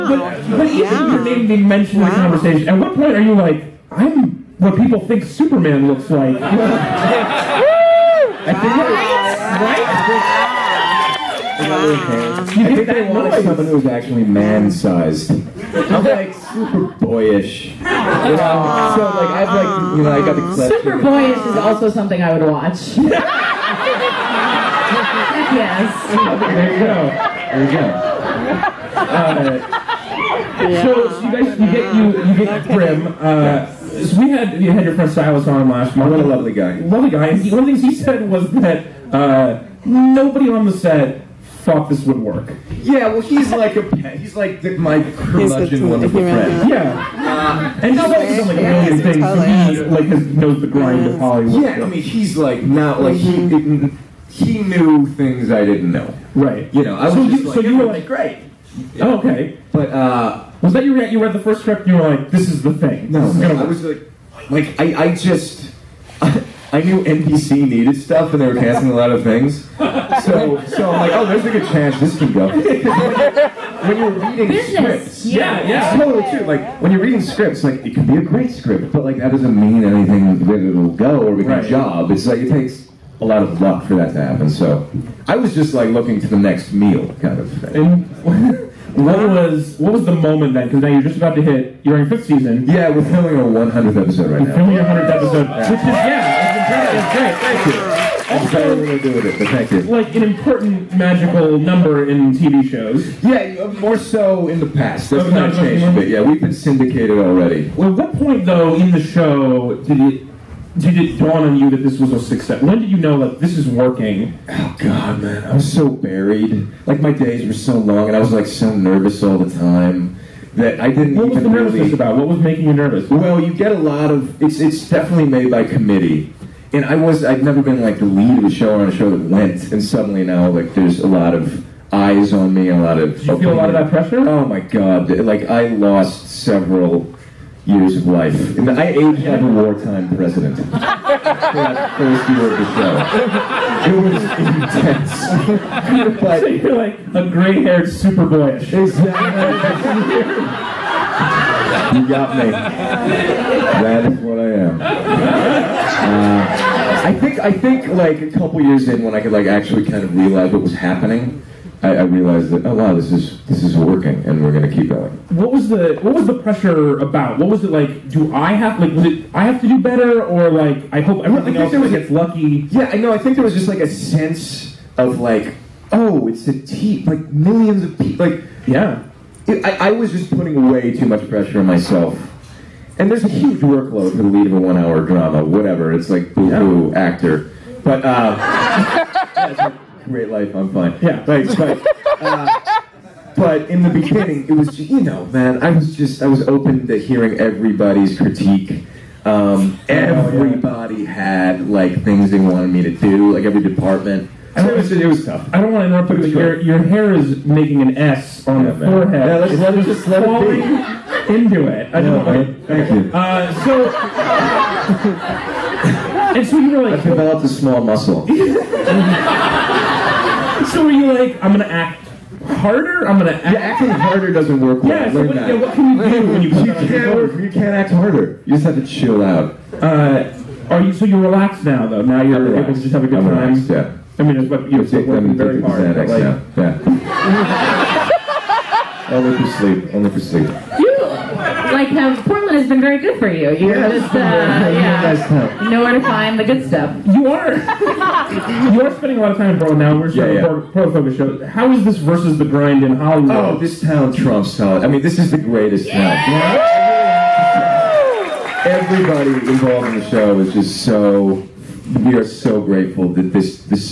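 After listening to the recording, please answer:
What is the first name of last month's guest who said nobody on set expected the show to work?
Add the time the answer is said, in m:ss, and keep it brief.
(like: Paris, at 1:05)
Silas, at 0:35.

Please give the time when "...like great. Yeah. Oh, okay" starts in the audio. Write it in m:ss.
0:57.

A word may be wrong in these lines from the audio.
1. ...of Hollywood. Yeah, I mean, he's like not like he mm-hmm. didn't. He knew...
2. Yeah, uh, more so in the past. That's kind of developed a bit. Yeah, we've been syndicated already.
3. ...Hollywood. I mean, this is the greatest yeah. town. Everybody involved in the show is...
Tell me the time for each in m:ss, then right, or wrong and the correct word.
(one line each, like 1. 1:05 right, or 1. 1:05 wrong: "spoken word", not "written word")
1. 0:51 right
2. 1:43 wrong: "changed", not "developed"
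3. 4:14 right.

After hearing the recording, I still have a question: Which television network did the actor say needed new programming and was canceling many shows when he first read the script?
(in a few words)
NBC.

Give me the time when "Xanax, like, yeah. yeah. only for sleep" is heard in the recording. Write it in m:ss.
3:55.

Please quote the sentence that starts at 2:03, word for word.
Well, you get a lot of it's.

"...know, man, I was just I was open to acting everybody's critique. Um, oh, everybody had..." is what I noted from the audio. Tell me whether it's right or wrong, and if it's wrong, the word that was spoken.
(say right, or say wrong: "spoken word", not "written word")
wrong: "hearing", not "acting".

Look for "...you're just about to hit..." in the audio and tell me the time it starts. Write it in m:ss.
1:30.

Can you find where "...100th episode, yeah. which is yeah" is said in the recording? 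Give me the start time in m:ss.
1:34.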